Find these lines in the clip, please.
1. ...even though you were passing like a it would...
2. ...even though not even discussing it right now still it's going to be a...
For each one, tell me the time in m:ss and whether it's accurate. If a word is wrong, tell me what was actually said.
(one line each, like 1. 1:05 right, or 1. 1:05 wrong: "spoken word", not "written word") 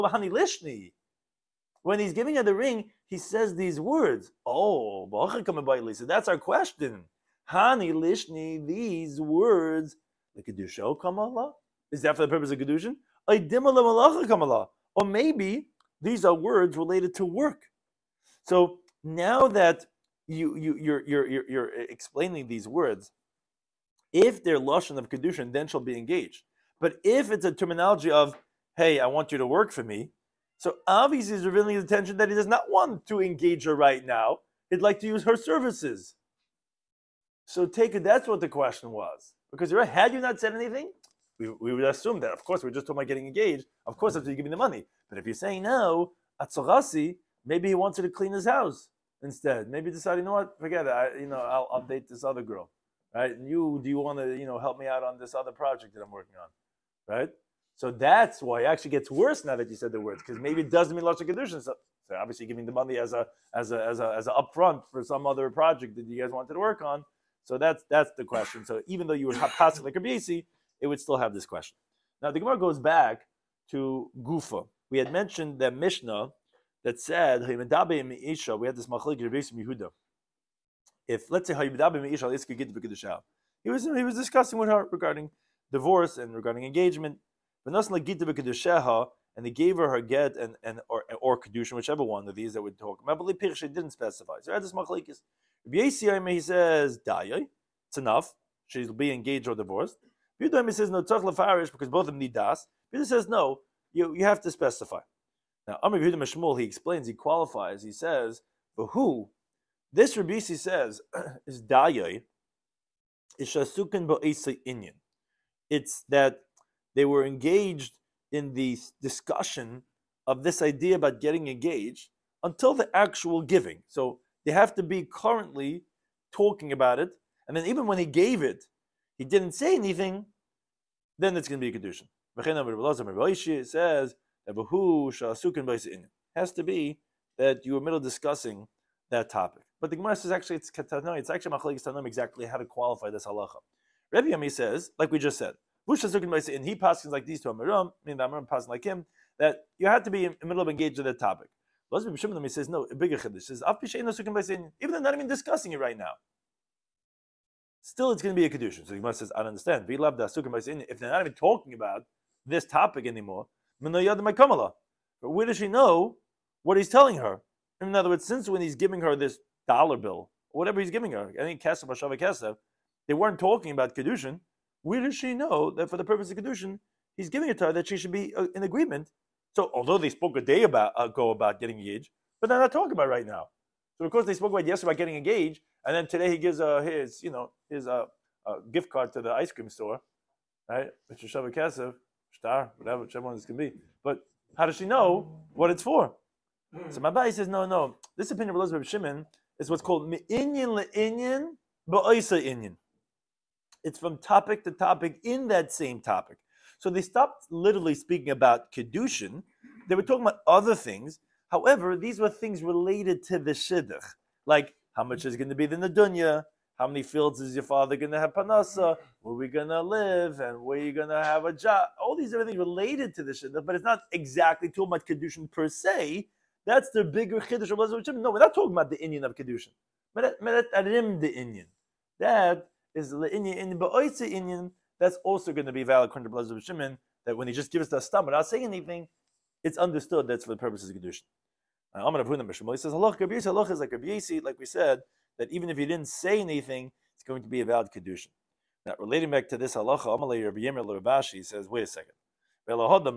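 1. 1:08 right
2. 2:34 right.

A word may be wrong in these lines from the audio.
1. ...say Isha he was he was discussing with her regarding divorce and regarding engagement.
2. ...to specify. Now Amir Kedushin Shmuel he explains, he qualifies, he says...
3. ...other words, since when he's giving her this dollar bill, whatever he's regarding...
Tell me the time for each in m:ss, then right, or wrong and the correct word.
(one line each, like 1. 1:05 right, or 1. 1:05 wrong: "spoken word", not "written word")
1. 1:21 right
2. 1:44 wrong: "Yudim", not "Kedushin"
3. 2:47 wrong: "giving", not "regarding".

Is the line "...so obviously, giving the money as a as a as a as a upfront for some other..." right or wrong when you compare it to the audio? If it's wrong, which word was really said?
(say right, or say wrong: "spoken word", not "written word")
right.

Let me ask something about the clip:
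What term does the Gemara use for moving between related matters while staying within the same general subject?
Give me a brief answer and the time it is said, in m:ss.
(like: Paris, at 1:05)
me'inyin le'inyin ba'oisa inyin, at 3:20.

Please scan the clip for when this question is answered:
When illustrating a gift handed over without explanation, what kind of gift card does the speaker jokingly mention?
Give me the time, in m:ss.
3:09.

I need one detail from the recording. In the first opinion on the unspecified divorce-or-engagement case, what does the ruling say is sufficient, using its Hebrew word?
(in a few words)
dayay.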